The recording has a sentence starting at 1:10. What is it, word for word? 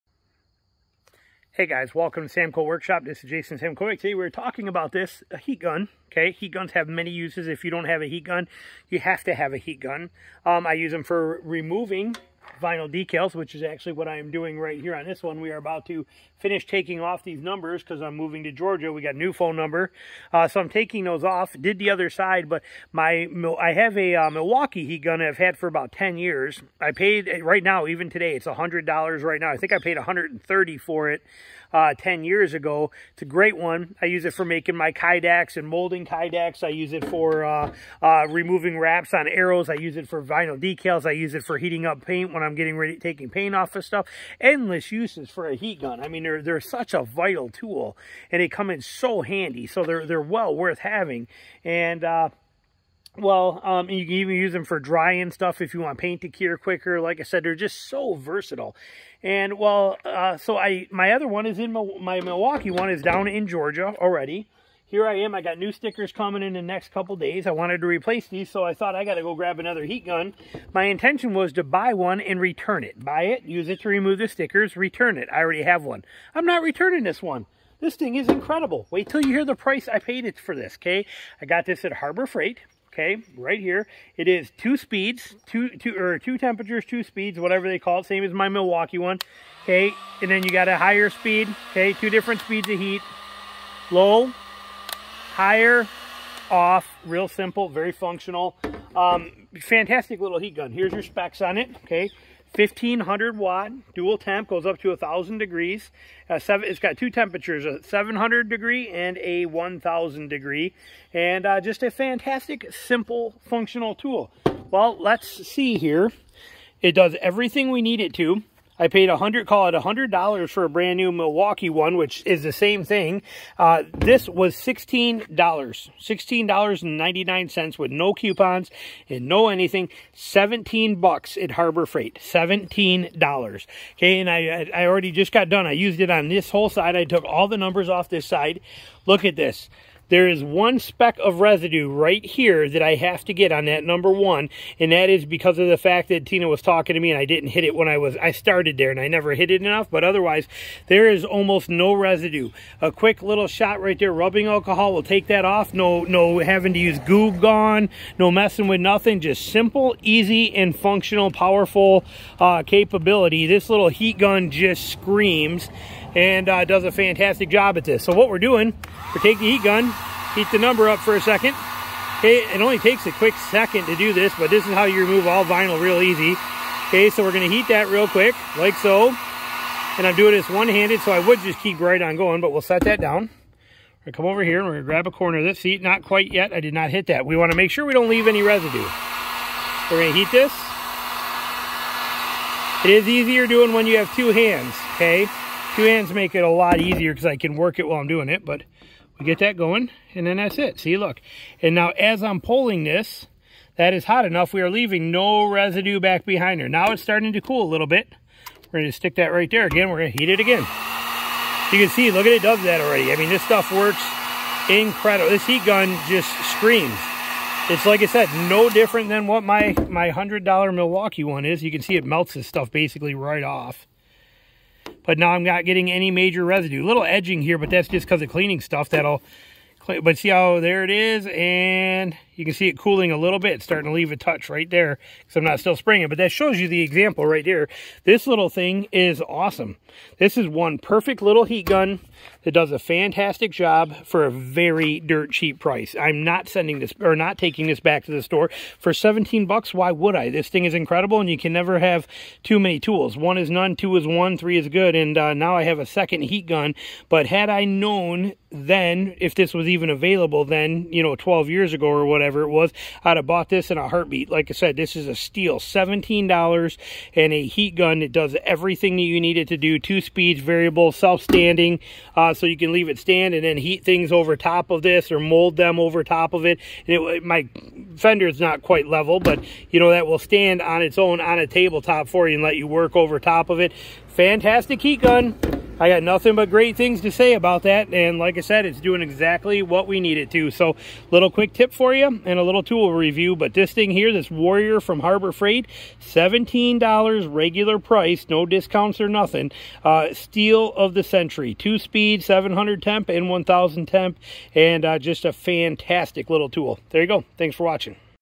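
My intention was to buy one and return it.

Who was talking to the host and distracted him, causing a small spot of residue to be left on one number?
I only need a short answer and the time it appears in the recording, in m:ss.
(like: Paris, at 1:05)
Tina, at 2:26.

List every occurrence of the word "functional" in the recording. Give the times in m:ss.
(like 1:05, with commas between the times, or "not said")
1:37, 1:53, 2:40.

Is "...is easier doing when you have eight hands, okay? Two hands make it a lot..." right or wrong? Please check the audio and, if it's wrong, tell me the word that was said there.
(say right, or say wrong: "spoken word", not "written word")
wrong: "two", not "eight".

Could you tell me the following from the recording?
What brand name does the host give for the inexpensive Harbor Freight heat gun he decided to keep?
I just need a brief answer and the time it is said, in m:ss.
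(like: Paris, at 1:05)
Warrior, at 4:54.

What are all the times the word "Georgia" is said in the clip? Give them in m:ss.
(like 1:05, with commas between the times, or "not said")
0:18, 1:03.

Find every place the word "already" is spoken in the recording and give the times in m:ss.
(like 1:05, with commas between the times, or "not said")
1:03, 1:15, 2:14, 3:32.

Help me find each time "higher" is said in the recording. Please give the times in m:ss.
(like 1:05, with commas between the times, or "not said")
1:30, 1:35.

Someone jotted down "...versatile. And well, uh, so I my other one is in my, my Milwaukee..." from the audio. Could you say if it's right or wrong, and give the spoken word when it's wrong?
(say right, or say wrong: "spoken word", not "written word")
right.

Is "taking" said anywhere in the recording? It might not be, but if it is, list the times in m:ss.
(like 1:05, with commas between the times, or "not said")
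0:16, 0:20, 0:42, 4:07.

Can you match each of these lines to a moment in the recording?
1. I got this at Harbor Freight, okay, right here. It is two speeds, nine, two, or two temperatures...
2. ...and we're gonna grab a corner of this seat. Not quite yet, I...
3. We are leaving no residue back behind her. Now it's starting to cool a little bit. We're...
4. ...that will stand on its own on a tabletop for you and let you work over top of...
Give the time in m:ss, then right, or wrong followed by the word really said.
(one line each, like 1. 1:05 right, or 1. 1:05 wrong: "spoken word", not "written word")
1. 1:21 wrong: "two", not "nine"
2. 3:04 right
3. 3:24 right
4. 4:39 right.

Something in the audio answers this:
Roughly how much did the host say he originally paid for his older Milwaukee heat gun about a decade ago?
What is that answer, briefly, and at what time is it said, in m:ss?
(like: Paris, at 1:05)
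$130, at 0:29.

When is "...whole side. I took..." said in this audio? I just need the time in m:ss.
2:16.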